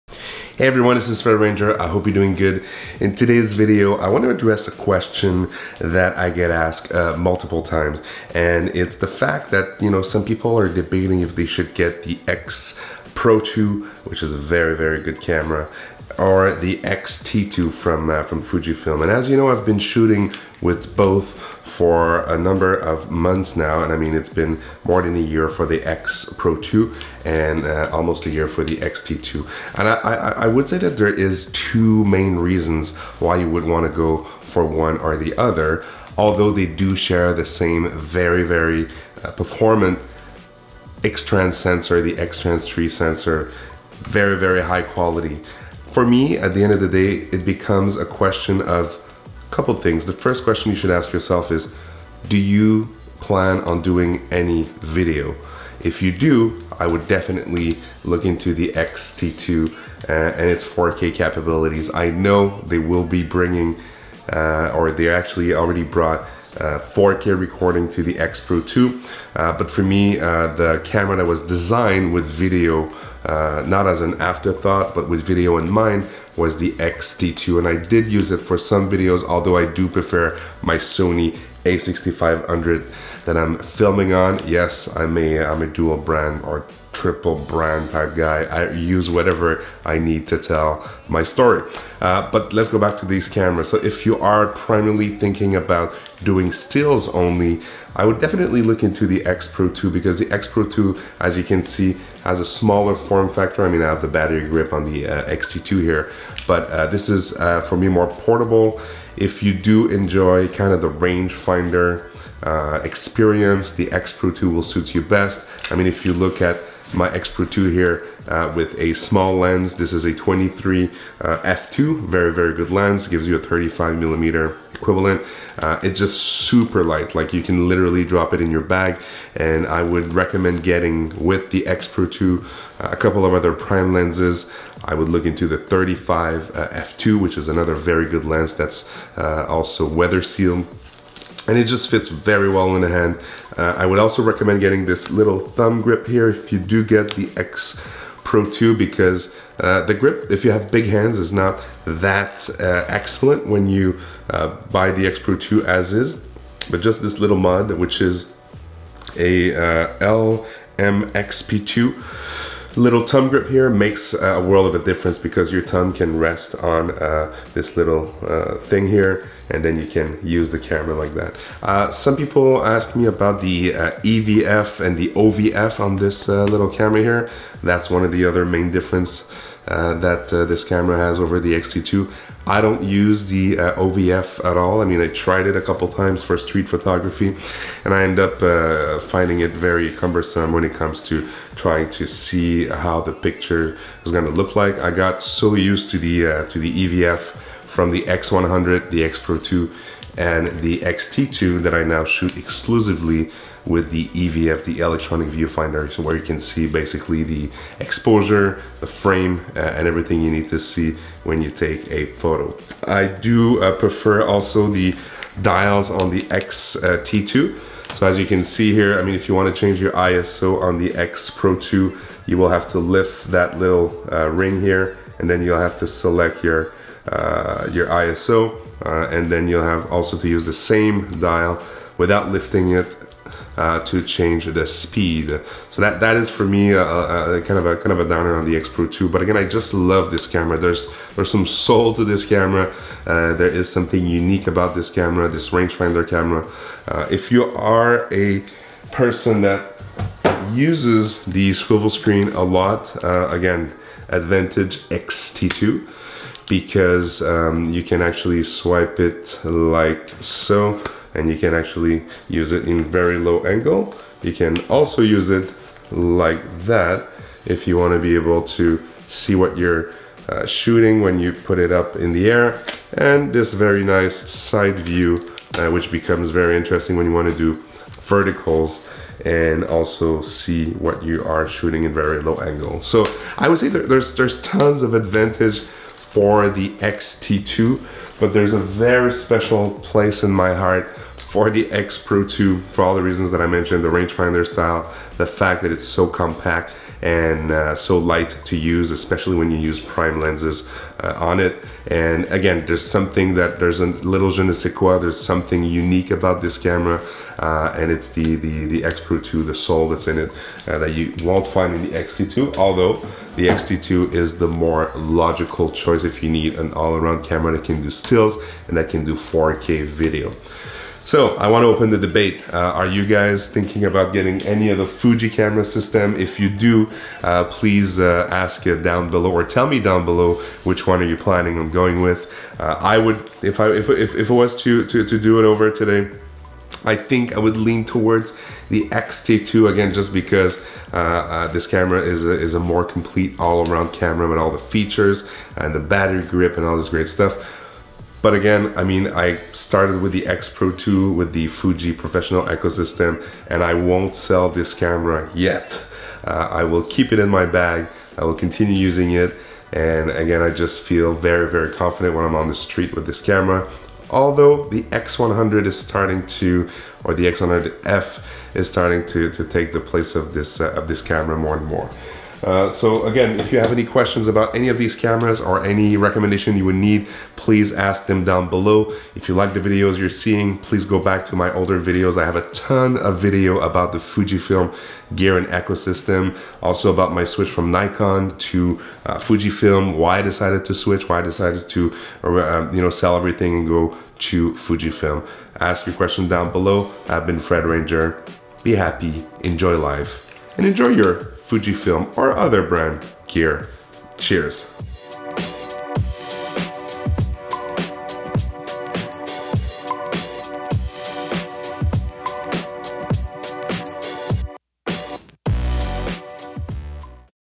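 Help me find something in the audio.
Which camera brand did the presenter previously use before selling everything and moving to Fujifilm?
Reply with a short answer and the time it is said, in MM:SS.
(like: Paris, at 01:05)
Nikon, at 06:27.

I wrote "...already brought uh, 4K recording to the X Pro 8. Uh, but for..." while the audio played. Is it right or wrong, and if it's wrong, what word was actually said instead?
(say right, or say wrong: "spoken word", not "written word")
wrong: "2", not "8".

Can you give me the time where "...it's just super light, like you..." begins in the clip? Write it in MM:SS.
02:05.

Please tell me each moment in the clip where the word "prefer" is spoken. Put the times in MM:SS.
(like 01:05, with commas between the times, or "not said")
01:19, 03:33.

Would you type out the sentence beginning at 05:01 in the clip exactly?
And again, there's something that there's a little je ne sais quoi, there's something unique about this camera.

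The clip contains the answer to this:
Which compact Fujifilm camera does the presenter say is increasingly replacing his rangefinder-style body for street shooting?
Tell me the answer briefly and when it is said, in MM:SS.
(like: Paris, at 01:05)
X100F, at 06:07.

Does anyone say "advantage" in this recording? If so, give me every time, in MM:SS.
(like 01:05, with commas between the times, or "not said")
04:14, 04:44.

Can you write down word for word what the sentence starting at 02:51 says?
Uh, some people asked me about the uh, EVF and the OVF on this uh, little camera here.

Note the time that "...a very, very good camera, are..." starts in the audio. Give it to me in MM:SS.
00:14.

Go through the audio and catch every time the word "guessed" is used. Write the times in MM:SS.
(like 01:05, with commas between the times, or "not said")
not said.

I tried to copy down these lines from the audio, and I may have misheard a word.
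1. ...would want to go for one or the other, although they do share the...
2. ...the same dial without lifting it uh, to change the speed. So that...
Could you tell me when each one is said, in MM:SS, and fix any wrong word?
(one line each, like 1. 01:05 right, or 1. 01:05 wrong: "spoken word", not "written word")
1. 00:33 right
2. 03:50 right.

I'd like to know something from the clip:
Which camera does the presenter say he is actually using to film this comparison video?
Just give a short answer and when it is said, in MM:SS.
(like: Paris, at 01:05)
Sony a6500, at 01:20.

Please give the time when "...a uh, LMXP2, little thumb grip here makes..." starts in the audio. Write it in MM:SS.
02:39.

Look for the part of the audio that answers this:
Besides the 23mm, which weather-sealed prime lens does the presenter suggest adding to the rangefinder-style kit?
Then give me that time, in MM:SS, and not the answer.
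02:15.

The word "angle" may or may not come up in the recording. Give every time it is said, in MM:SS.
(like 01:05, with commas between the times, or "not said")
04:23, 04:42.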